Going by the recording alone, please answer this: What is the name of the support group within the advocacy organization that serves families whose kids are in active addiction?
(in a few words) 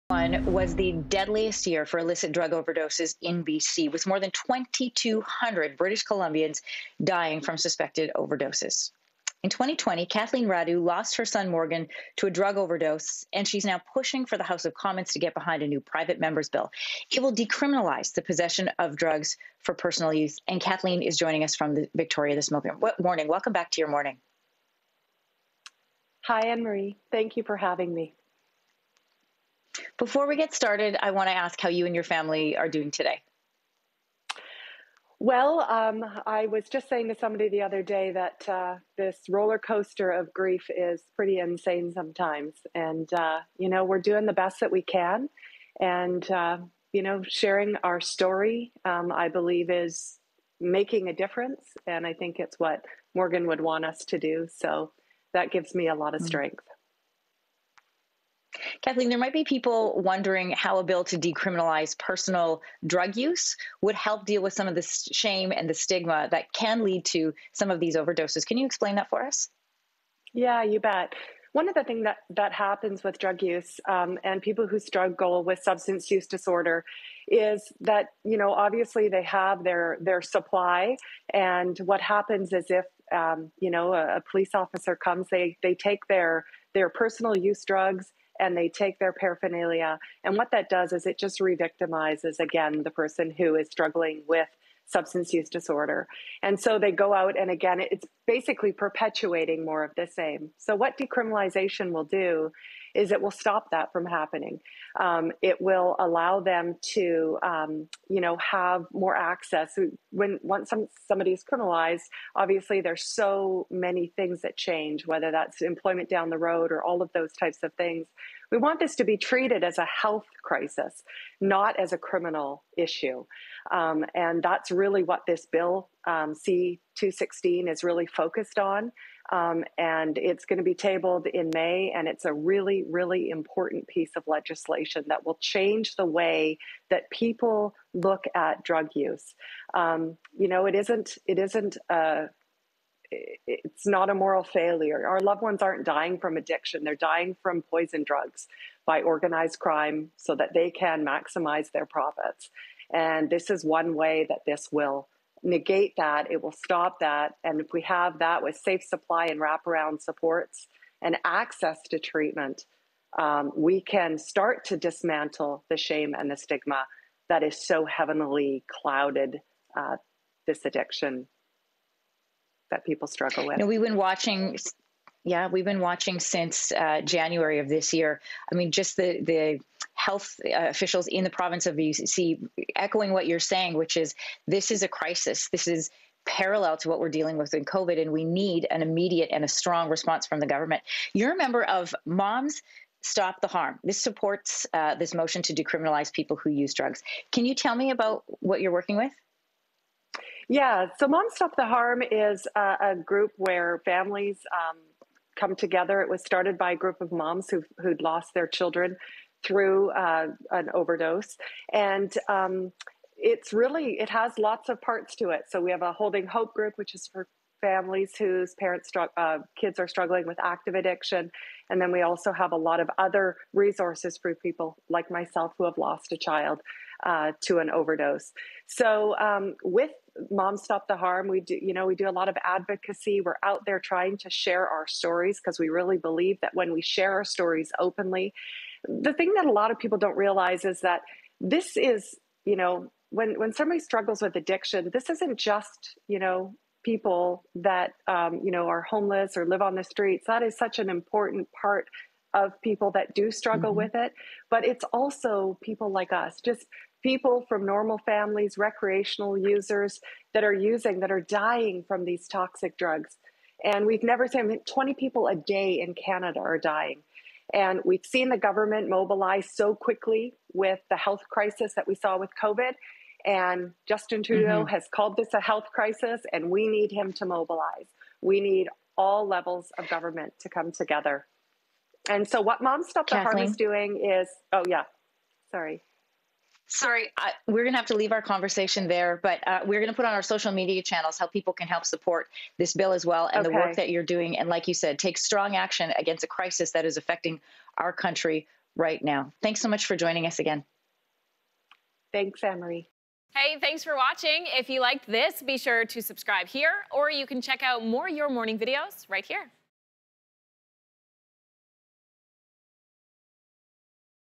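holding hope.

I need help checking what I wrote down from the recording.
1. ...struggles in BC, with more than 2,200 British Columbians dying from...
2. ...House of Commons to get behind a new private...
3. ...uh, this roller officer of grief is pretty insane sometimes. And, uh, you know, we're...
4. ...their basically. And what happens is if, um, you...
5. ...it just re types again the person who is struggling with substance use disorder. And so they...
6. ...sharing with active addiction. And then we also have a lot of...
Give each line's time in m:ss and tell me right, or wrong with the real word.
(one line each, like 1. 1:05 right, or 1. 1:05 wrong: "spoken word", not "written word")
1. 0:02 wrong: "overdoses", not "struggles"
2. 0:14 right
3. 0:38 wrong: "coaster", not "officer"
4. 1:19 wrong: "supply", not "basically"
5. 1:31 wrong: "victimizes", not "types"
6. 3:39 wrong: "struggling", not "sharing".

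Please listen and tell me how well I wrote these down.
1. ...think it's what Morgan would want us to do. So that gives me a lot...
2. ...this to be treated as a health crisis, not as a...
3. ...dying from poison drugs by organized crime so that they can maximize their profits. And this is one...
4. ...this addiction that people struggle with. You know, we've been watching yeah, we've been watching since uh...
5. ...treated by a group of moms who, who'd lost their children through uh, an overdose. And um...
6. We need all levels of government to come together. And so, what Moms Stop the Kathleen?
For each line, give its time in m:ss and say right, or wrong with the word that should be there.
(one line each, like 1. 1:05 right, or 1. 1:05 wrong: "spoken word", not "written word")
1. 0:52 right
2. 1:58 right
3. 2:26 right
4. 2:50 right
5. 3:26 wrong: "started", not "treated"
6. 4:38 right.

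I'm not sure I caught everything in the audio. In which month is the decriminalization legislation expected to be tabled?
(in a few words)
May.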